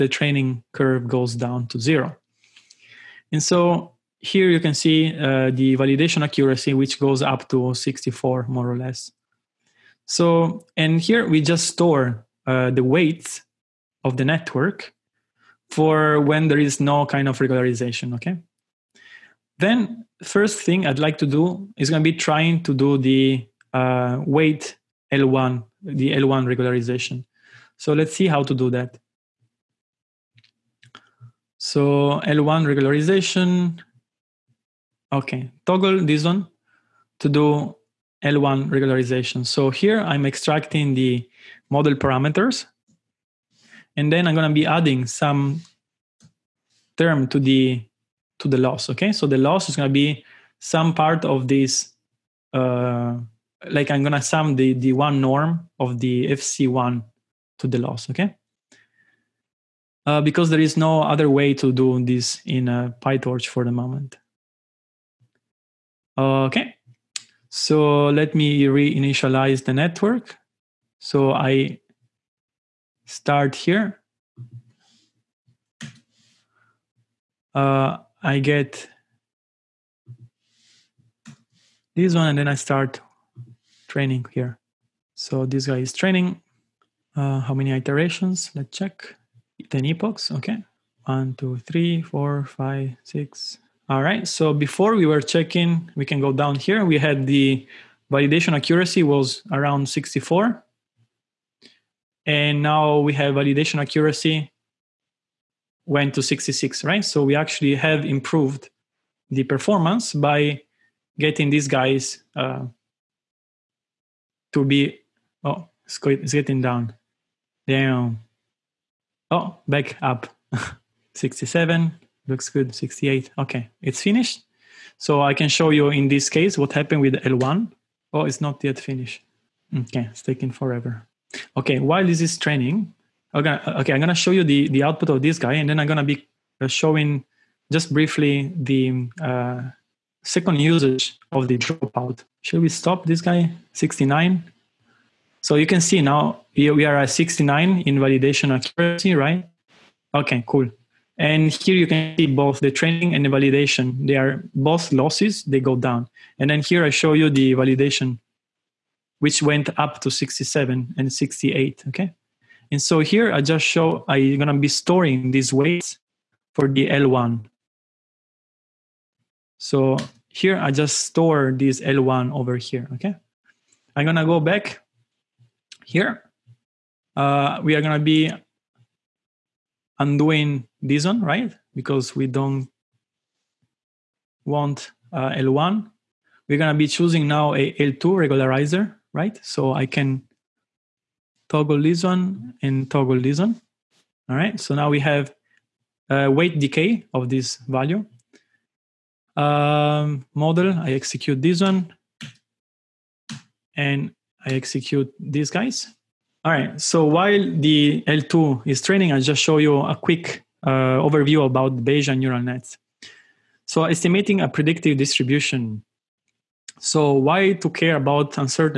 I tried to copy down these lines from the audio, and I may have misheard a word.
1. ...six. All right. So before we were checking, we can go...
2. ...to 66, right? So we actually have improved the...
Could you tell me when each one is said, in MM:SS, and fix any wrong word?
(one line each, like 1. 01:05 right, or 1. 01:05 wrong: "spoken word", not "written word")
1. 01:33 right
2. 01:46 right.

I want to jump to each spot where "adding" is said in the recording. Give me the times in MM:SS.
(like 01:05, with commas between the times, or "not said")
00:44.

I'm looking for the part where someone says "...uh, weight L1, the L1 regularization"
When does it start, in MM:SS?
00:23.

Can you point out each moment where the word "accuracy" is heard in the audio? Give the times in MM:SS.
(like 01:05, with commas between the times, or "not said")
00:06, 01:38, 01:43, 02:28.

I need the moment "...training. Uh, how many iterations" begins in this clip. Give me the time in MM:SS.
01:26.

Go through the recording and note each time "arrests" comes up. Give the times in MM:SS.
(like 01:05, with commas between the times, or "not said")
not said.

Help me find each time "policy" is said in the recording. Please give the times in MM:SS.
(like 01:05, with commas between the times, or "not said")
not said.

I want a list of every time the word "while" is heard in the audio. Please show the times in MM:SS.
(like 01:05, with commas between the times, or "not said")
02:11, 03:27.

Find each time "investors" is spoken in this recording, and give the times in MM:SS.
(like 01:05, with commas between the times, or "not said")
not said.